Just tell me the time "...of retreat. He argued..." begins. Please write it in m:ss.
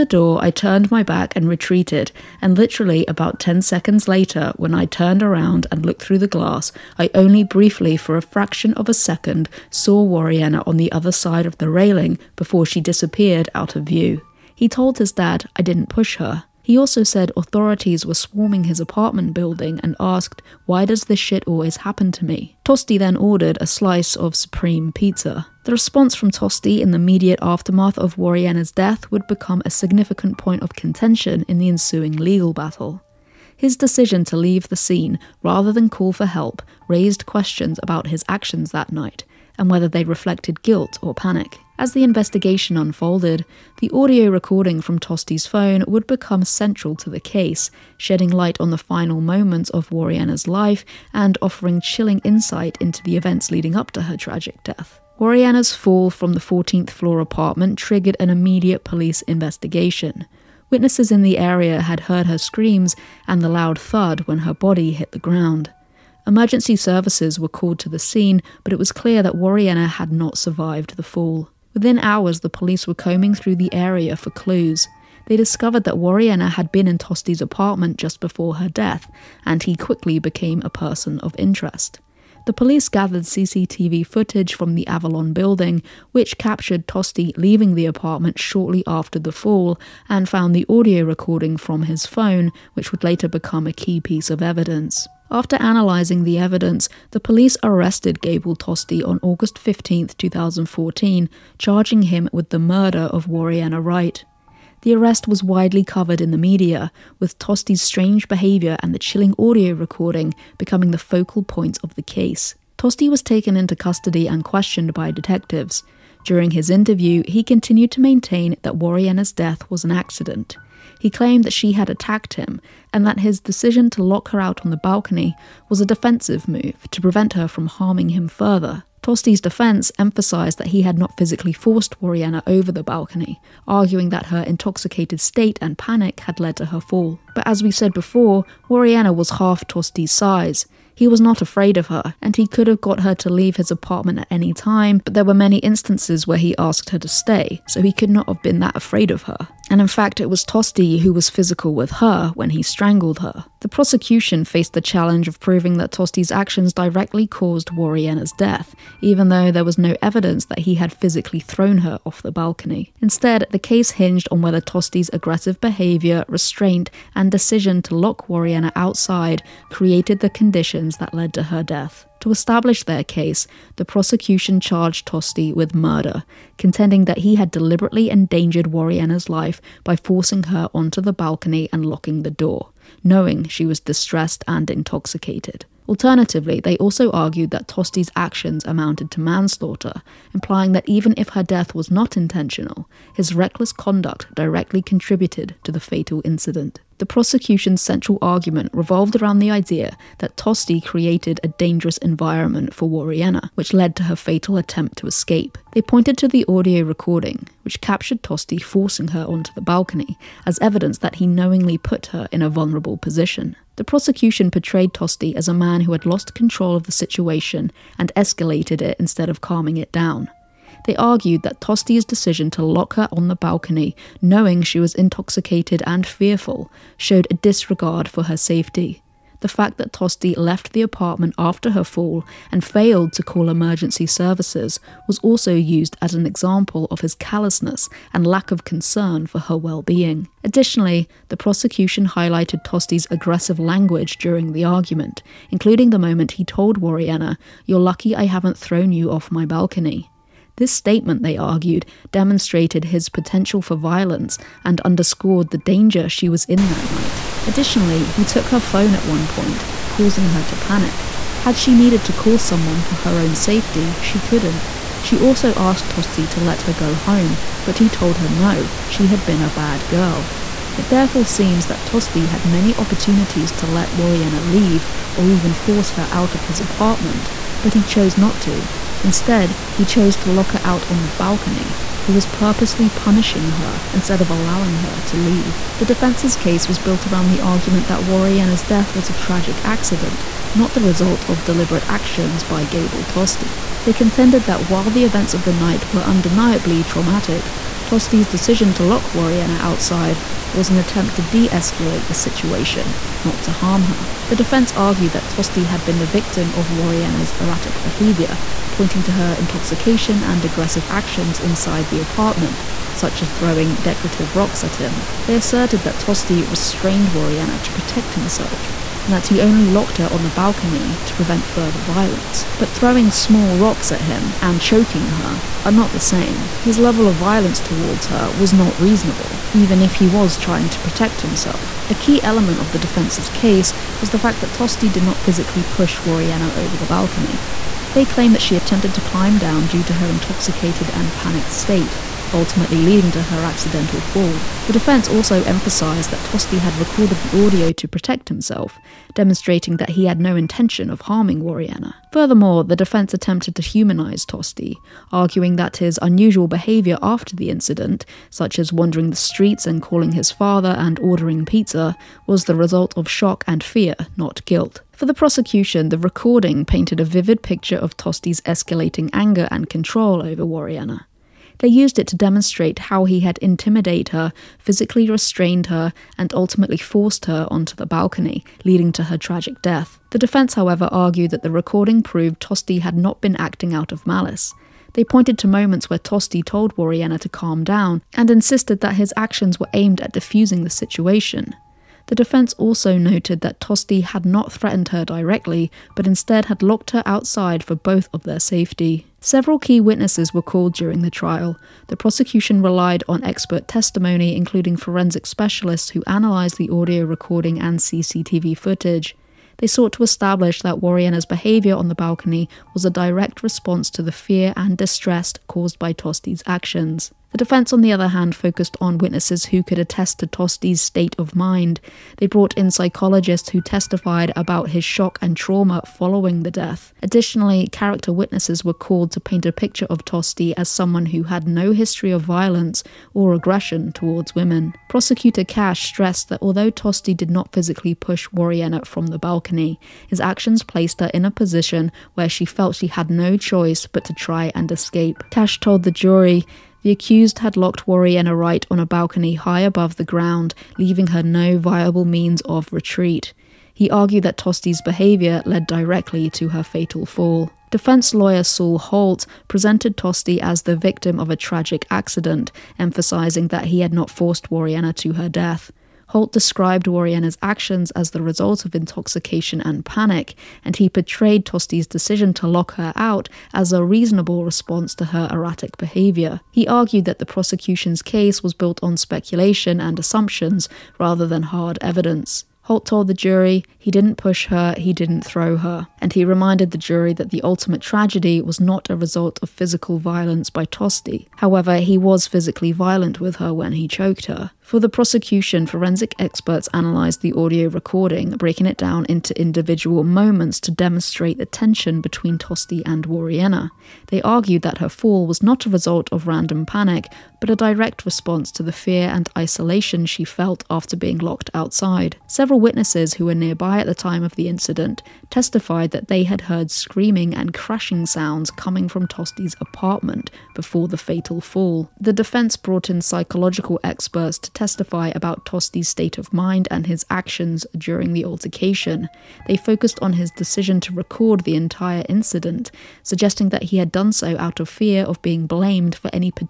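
7:32.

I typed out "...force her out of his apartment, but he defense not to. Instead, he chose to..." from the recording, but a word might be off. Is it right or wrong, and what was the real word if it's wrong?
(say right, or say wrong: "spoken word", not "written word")
wrong: "chose", not "defense".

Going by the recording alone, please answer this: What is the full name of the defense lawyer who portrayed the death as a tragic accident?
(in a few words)
Saul Holt.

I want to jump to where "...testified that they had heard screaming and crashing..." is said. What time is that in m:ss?
8:35.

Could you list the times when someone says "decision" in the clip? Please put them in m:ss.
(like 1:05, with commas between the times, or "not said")
0:33, 2:03, 2:47, 3:42, 4:58, 7:51, 8:50.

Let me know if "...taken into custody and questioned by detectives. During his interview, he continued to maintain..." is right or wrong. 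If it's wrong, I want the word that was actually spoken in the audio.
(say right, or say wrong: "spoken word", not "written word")
right.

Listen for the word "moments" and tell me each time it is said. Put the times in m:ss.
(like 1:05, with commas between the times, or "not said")
0:49, 4:05, 6:25, 8:20.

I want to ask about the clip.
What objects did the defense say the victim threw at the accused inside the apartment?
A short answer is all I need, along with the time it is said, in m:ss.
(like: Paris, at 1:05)
Decorative rocks, at 5:13.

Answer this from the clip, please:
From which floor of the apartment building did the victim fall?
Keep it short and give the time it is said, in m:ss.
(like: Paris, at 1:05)
14th floor, at 0:56.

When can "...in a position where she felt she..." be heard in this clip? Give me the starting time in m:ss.
7:21.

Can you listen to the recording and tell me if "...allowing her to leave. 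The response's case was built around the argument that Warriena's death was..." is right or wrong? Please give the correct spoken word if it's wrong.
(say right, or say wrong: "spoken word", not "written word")
wrong: "defense", not "response".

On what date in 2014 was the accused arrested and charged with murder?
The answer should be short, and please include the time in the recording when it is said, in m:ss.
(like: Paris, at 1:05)
August 15, at 1:39.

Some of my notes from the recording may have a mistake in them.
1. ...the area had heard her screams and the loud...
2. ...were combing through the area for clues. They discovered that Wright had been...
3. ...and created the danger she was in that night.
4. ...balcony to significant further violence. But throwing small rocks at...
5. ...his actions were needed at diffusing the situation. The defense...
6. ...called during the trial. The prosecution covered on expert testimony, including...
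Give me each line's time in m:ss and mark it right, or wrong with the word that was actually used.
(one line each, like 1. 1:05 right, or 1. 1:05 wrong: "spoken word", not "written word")
1. 1:01 right
2. 1:12 wrong: "Warriena", not "Wright"
3. 4:14 wrong: "underscored", not "created"
4. 5:20 wrong: "prevent", not "significant"
5. 6:28 wrong: "aimed", not "needed"
6. 6:40 wrong: "relied", not "covered".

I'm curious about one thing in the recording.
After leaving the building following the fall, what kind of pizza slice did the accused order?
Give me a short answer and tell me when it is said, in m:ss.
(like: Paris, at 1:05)
Supreme, at 0:24.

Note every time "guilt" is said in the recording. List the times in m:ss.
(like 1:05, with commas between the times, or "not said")
0:40, 6:04.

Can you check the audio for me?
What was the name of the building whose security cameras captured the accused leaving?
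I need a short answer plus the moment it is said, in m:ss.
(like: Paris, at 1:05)
Avalon, at 1:24.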